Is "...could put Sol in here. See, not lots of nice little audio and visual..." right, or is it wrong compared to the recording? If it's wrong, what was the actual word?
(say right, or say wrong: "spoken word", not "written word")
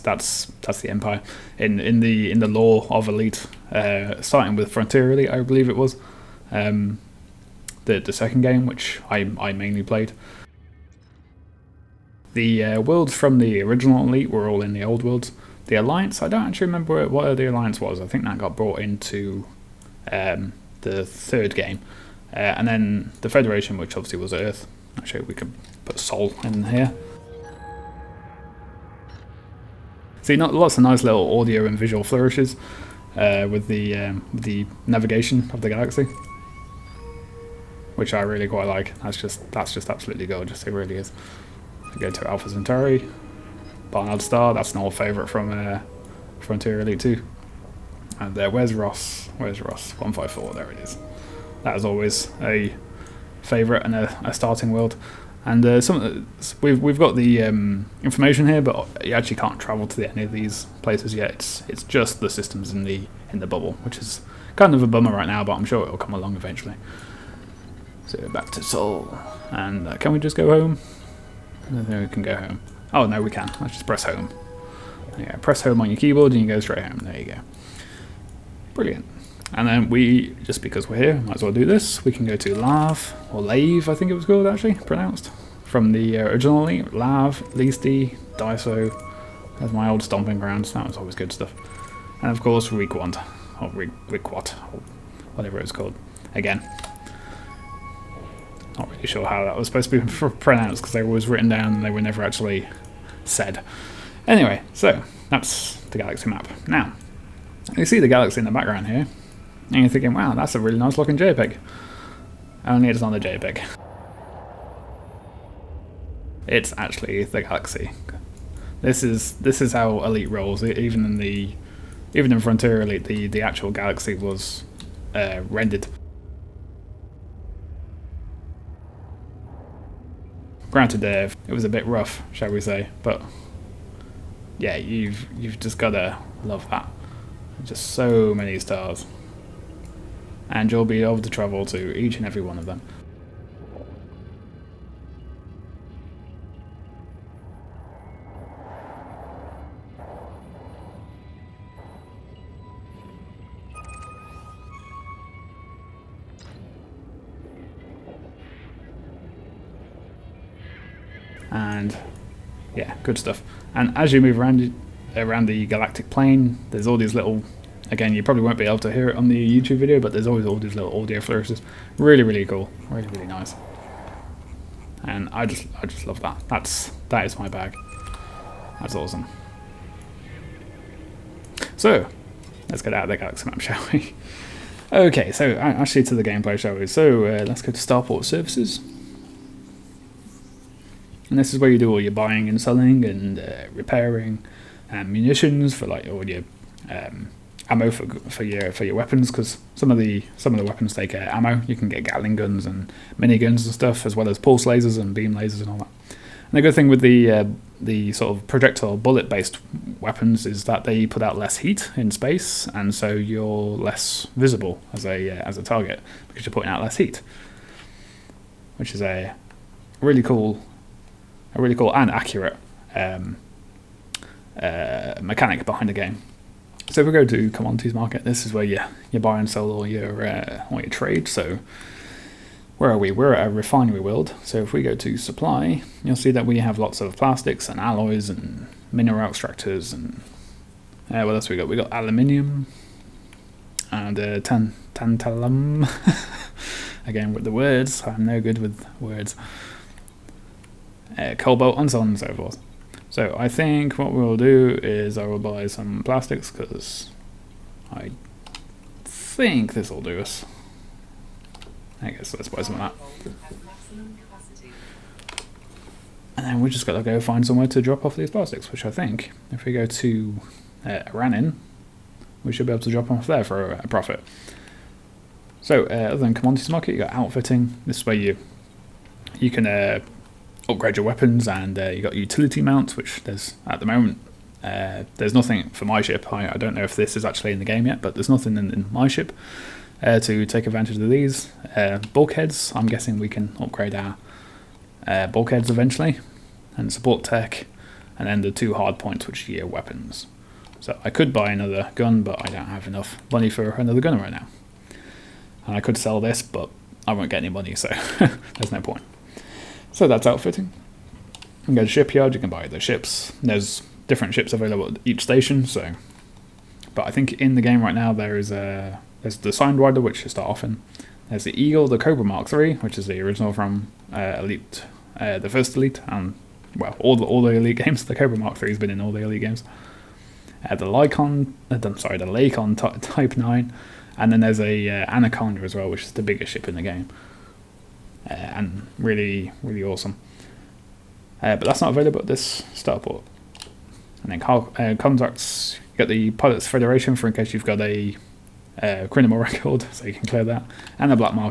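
right.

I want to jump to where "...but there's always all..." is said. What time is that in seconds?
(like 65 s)
169 s.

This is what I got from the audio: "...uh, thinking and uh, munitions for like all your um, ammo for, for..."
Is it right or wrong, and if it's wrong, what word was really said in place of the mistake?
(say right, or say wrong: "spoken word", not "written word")
wrong: "repairing", not "thinking".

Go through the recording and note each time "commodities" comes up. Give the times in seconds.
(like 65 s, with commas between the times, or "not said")
227 s, 276 s.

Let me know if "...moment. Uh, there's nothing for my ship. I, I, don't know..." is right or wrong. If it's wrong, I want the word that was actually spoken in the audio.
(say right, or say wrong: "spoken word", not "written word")
right.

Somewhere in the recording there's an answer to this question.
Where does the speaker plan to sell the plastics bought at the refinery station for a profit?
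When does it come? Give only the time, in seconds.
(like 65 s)
271 s.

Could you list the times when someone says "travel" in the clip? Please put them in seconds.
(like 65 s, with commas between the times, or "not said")
59 s, 141 s.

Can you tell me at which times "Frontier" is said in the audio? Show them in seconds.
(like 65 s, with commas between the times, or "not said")
4 s, 46 s, 122 s.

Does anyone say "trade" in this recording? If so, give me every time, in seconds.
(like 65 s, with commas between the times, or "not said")
230 s.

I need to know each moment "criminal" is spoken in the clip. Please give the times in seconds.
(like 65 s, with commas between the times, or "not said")
349 s.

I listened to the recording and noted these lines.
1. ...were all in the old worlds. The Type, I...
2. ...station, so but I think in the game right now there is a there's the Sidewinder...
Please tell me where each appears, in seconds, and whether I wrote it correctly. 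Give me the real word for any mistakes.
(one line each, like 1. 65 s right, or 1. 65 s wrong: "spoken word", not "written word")
1. 14 s wrong: "Alliance", not "Type"
2. 315 s right.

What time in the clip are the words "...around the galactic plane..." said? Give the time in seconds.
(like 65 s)
165 s.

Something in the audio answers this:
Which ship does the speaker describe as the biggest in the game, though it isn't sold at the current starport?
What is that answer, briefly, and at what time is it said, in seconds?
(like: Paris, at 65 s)
Anaconda, at 335 s.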